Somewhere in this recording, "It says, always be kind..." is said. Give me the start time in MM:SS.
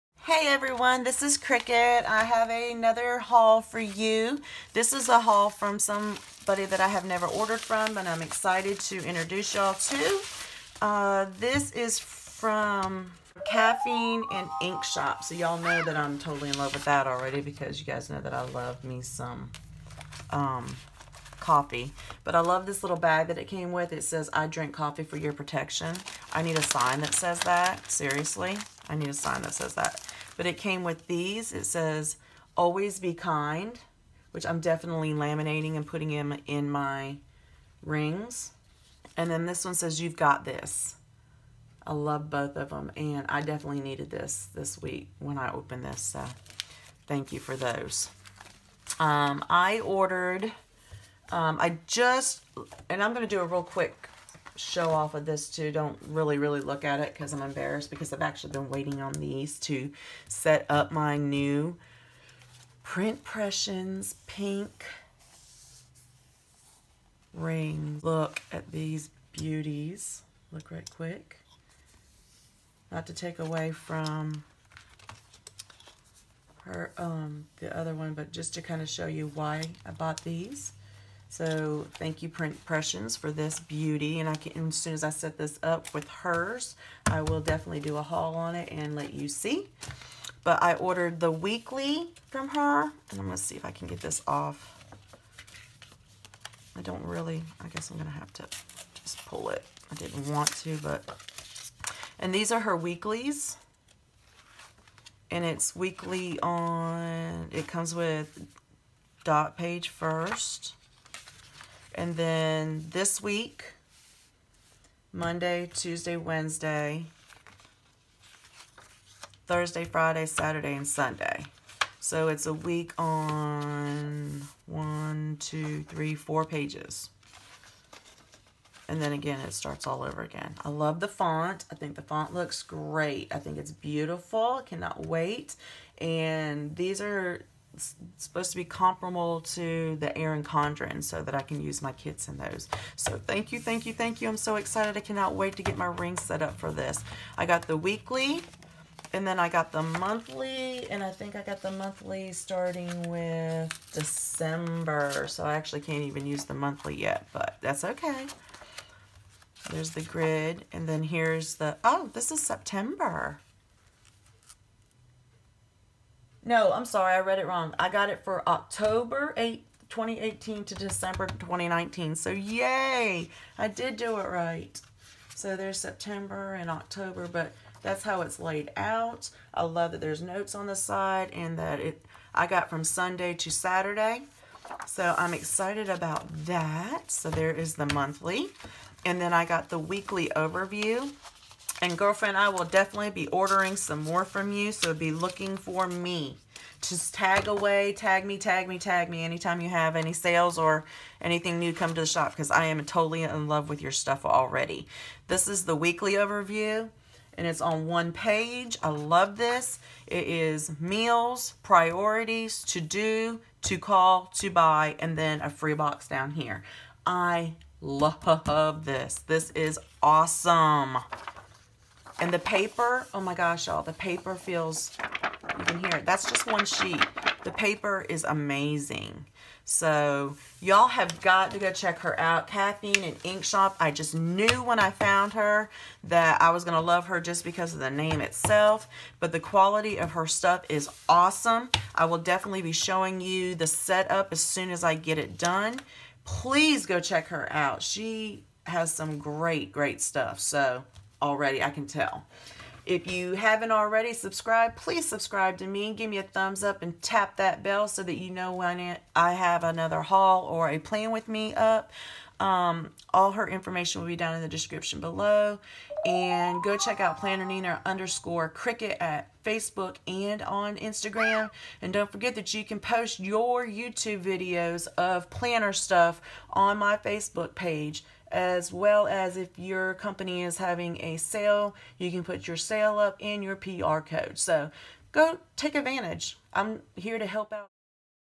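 00:31.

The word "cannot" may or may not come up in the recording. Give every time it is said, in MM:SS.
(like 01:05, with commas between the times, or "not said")
02:14, 02:24.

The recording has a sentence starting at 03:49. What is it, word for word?
So y'all have got to go check her out.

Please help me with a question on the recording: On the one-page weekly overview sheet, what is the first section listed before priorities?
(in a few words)
Meals.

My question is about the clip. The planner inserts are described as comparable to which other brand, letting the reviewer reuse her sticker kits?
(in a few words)
Erin Condren.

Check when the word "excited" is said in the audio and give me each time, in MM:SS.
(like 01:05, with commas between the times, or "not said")
00:08, 02:24, 03:05.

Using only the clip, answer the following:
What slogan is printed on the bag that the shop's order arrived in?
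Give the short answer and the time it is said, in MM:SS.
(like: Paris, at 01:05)
I drink coffee for your protection, at 00:24.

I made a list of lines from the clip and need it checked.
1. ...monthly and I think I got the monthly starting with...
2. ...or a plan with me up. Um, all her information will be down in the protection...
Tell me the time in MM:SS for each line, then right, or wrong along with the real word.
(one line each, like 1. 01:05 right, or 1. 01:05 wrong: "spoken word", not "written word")
1. 02:29 right
2. 04:20 wrong: "description", not "protection".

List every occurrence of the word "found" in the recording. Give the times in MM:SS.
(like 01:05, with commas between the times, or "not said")
03:54.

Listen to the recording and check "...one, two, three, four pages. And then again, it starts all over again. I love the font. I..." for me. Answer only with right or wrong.
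right.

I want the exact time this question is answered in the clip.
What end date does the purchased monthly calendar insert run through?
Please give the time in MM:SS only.
02:50.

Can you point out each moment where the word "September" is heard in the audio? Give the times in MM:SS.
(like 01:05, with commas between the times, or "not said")
02:42, 02:55.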